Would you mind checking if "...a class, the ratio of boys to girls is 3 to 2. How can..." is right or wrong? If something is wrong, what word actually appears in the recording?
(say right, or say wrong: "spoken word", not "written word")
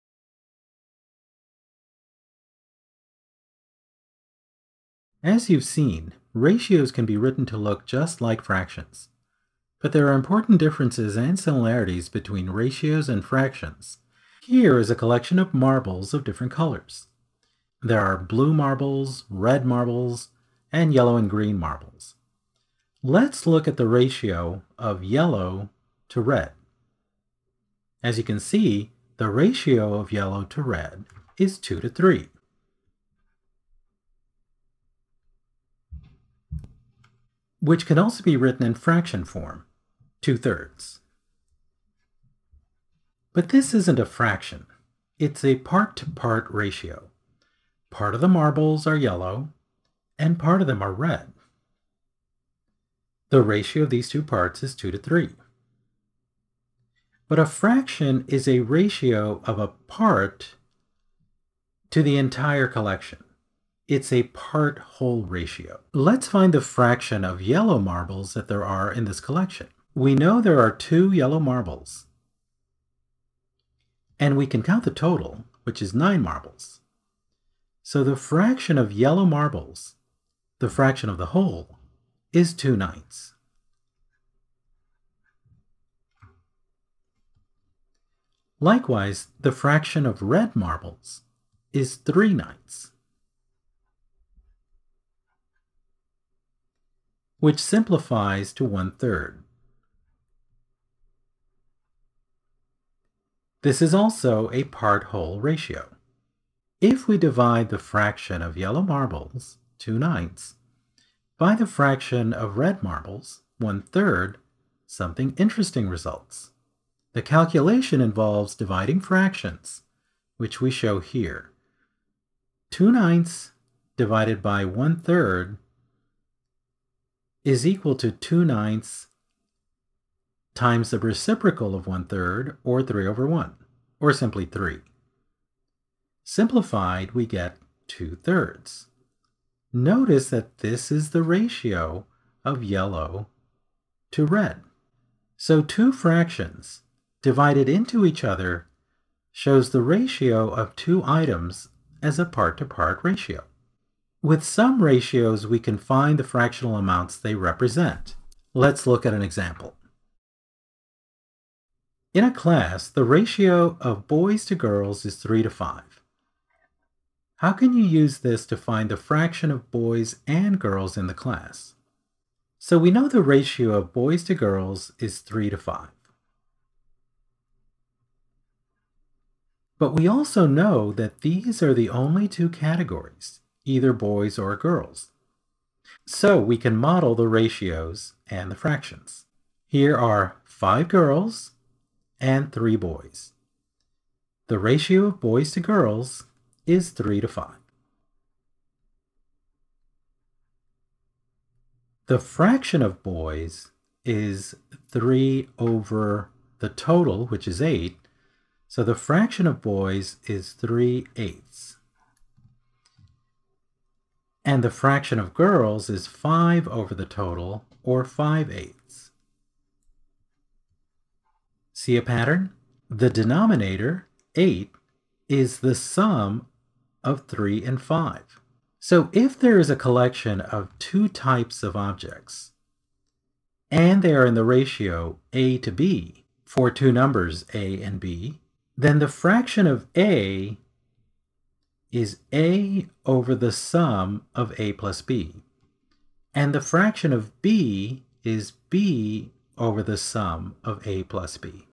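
wrong: "5", not "2".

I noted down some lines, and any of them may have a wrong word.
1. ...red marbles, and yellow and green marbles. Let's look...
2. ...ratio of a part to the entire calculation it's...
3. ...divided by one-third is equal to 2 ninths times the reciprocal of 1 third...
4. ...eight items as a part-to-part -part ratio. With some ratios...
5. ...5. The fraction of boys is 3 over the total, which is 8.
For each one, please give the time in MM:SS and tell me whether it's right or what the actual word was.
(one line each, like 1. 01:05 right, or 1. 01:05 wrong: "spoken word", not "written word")
1. 00:19 right
2. 00:58 wrong: "collection", not "calculation"
3. 02:03 right
4. 02:30 wrong: "two", not "eight"
5. 03:17 right.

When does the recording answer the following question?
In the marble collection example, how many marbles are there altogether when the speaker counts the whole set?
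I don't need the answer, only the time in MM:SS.
01:15.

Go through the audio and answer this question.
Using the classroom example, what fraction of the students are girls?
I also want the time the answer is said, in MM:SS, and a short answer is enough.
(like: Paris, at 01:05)
5/8, at 03:38.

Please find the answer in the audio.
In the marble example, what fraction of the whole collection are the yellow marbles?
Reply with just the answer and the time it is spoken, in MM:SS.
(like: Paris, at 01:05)
2/9, at 01:22.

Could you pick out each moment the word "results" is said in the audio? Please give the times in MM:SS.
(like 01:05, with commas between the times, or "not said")
01:55.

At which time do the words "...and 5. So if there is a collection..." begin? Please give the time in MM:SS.
03:47.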